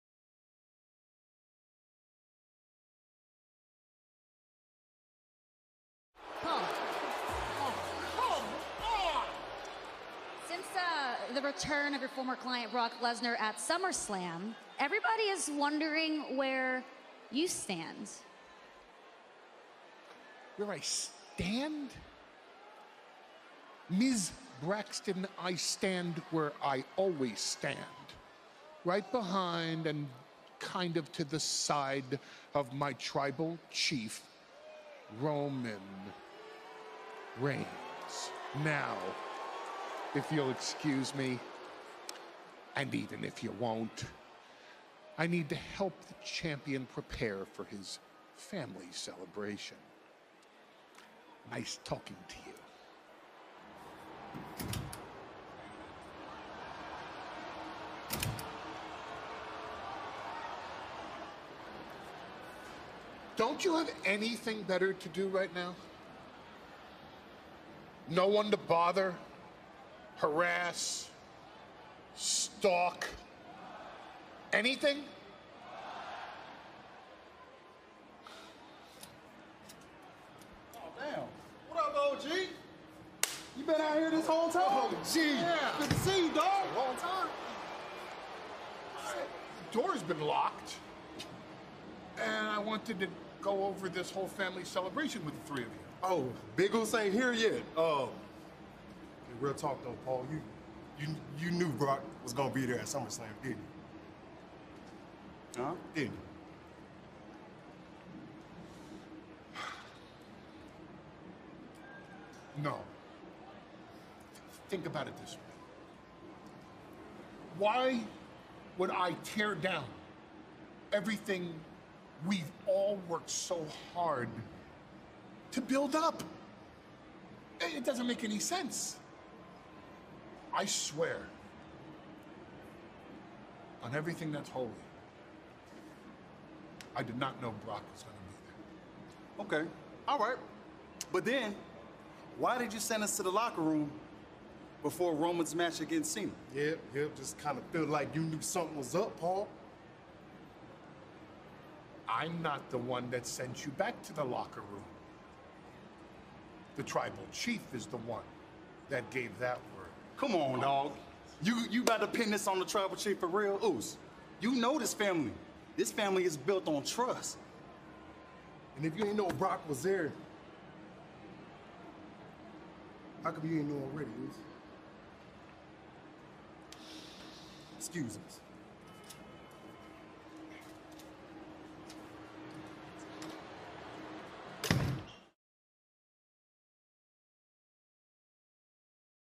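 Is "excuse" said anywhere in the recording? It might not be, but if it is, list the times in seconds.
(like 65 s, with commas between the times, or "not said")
40 s, 177 s.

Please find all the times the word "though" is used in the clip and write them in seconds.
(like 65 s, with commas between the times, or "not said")
99 s.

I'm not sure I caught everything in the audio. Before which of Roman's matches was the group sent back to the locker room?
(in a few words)
Cena.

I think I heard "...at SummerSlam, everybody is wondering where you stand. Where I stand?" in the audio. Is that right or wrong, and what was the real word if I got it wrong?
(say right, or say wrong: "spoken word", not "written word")
right.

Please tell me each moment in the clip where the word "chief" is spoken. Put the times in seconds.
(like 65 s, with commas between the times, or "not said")
33 s, 157 s, 162 s.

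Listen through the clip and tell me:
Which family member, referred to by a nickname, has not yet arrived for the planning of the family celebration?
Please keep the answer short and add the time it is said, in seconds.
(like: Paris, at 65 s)
Biggles, at 96 s.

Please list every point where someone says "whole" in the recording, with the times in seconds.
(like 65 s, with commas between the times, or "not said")
84 s, 94 s.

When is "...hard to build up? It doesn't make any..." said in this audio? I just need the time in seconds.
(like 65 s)
123 s.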